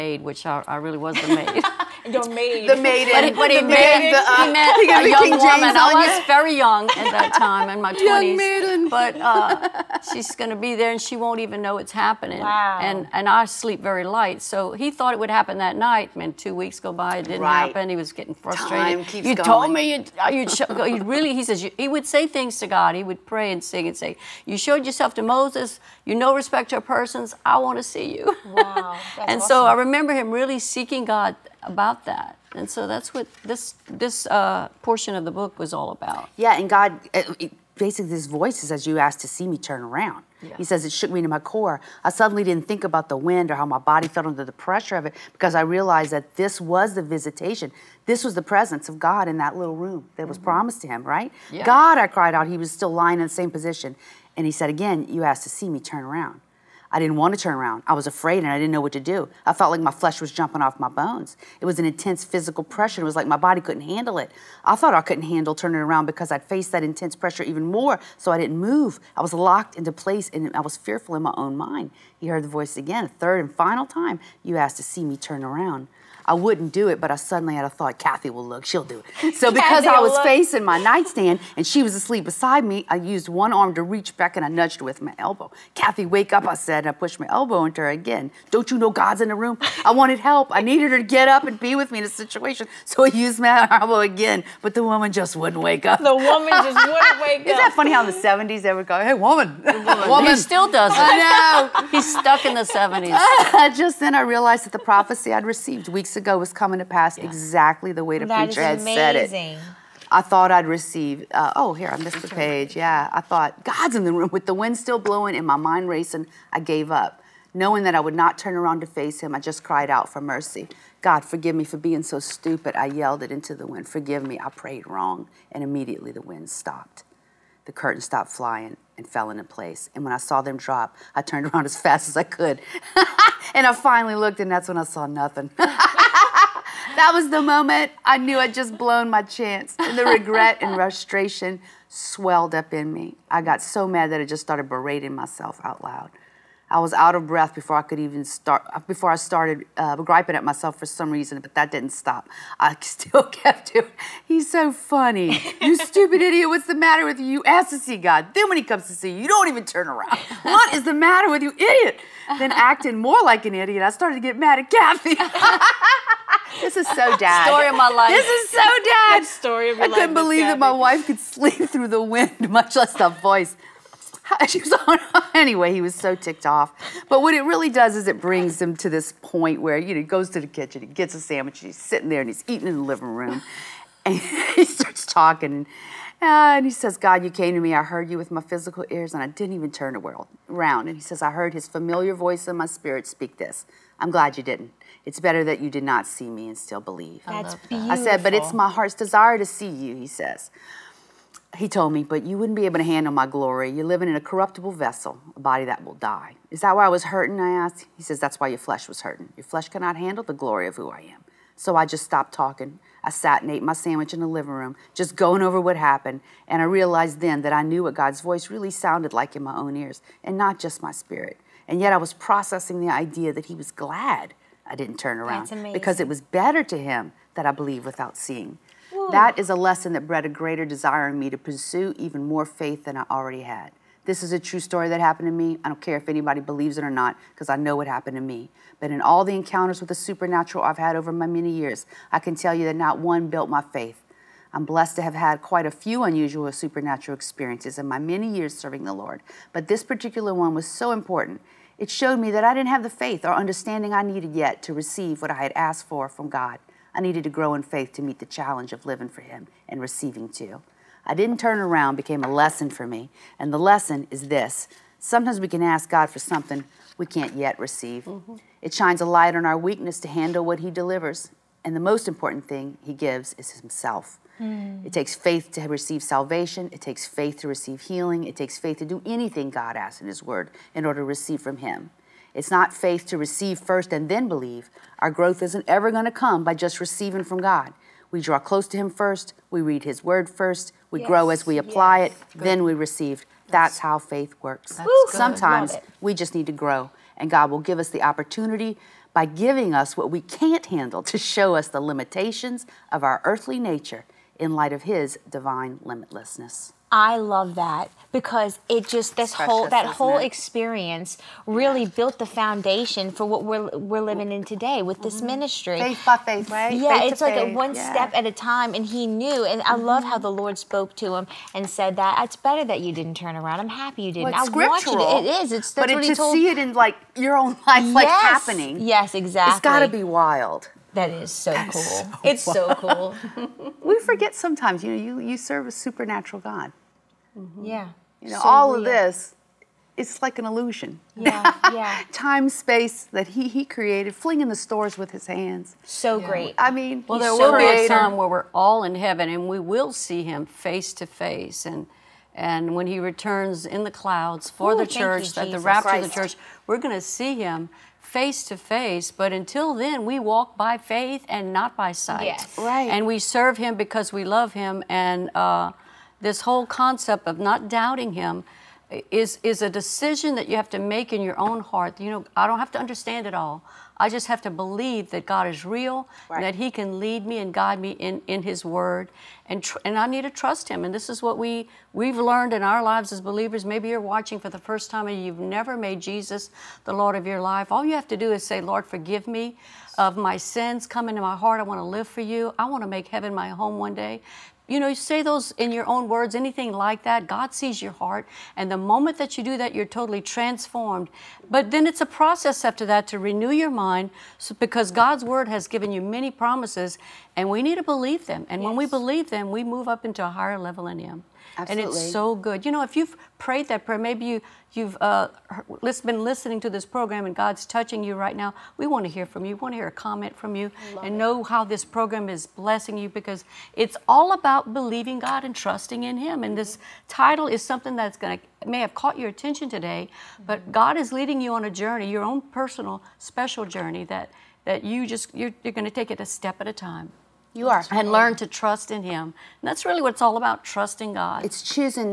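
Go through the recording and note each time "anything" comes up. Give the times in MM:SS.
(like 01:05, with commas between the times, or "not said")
04:39, 06:36.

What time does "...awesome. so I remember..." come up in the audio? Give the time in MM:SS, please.
00:29.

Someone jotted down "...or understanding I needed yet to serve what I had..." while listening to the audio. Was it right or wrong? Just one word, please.
wrong.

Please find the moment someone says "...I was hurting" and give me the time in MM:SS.
03:26.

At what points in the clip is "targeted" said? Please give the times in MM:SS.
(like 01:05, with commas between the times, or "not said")
not said.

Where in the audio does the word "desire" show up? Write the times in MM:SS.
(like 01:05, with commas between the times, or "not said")
03:18, 03:50.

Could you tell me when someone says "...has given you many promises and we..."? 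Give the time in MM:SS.
06:45.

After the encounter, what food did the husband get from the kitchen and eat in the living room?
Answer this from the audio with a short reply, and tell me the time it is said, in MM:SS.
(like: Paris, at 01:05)
A sandwich, at 03:01.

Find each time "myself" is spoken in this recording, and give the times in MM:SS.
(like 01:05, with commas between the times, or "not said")
02:25, 02:30.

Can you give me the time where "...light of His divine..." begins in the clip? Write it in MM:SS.
05:04.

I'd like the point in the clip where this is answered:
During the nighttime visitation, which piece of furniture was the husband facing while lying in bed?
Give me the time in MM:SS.
01:20.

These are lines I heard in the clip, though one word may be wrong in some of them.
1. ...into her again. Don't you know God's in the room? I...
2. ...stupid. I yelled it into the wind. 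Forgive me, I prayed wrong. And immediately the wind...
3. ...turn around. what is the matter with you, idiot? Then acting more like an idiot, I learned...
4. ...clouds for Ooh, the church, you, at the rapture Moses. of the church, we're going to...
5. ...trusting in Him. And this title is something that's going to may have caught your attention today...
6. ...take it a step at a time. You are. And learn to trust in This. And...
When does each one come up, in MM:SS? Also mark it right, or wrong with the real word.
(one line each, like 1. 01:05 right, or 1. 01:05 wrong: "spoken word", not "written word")
1. 01:27 right
2. 02:02 right
3. 02:39 wrong: "started", not "learned"
4. 05:53 wrong: "Christ", not "Moses"
5. 07:05 right
6. 07:15 wrong: "Him", not "This".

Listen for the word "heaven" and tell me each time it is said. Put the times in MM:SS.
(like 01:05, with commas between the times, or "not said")
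05:48, 06:33.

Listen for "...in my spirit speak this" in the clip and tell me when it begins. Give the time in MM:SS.
03:12.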